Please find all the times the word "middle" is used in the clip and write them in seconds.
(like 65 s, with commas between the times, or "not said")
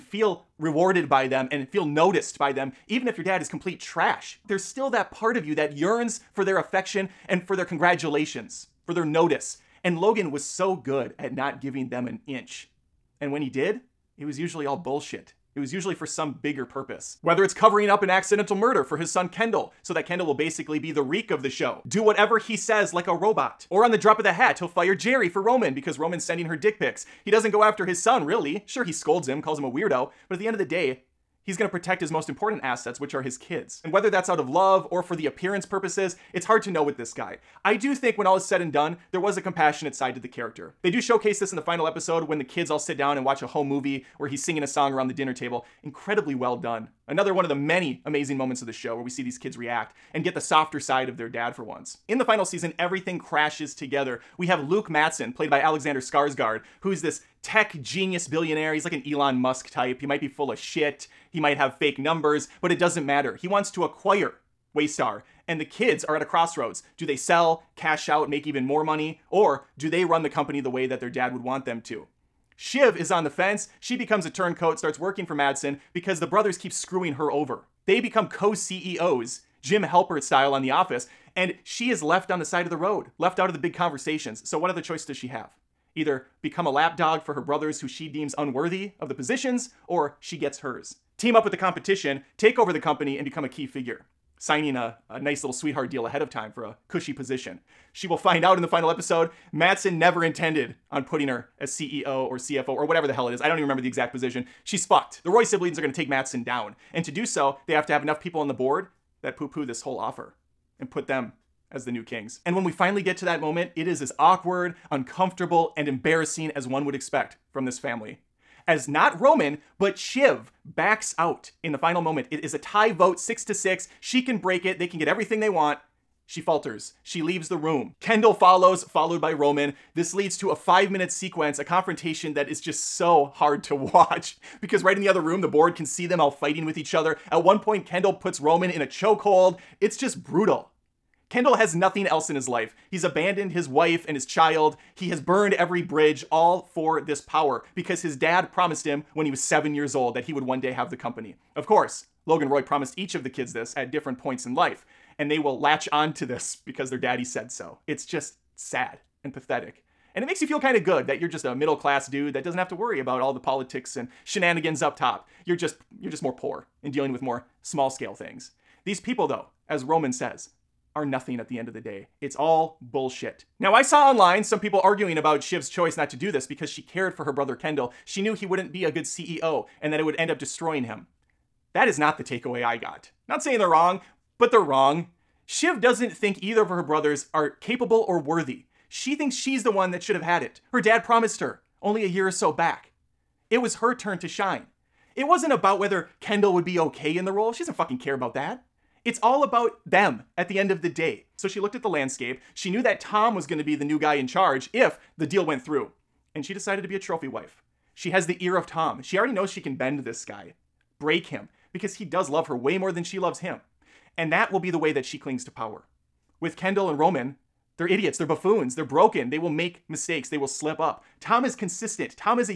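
161 s.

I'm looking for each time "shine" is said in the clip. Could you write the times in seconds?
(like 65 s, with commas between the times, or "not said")
194 s.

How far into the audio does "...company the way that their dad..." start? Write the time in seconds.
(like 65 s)
70 s.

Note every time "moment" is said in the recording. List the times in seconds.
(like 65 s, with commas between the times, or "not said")
48 s, 113 s, 122 s.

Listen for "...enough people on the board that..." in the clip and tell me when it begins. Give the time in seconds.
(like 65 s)
108 s.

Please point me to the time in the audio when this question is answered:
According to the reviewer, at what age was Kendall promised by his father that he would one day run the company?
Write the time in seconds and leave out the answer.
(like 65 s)
149 s.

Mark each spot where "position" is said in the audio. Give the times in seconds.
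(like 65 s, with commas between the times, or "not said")
89 s, 97 s, 104 s.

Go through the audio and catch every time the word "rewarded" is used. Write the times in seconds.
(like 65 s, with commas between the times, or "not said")
0 s.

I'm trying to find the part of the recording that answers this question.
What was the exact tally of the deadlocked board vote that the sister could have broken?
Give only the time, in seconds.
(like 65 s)
123 s.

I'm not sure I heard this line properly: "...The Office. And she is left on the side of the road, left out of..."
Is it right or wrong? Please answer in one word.
right.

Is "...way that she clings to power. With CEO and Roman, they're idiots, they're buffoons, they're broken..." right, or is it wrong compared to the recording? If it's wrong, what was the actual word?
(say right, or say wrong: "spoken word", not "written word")
wrong: "Kendall", not "CEO".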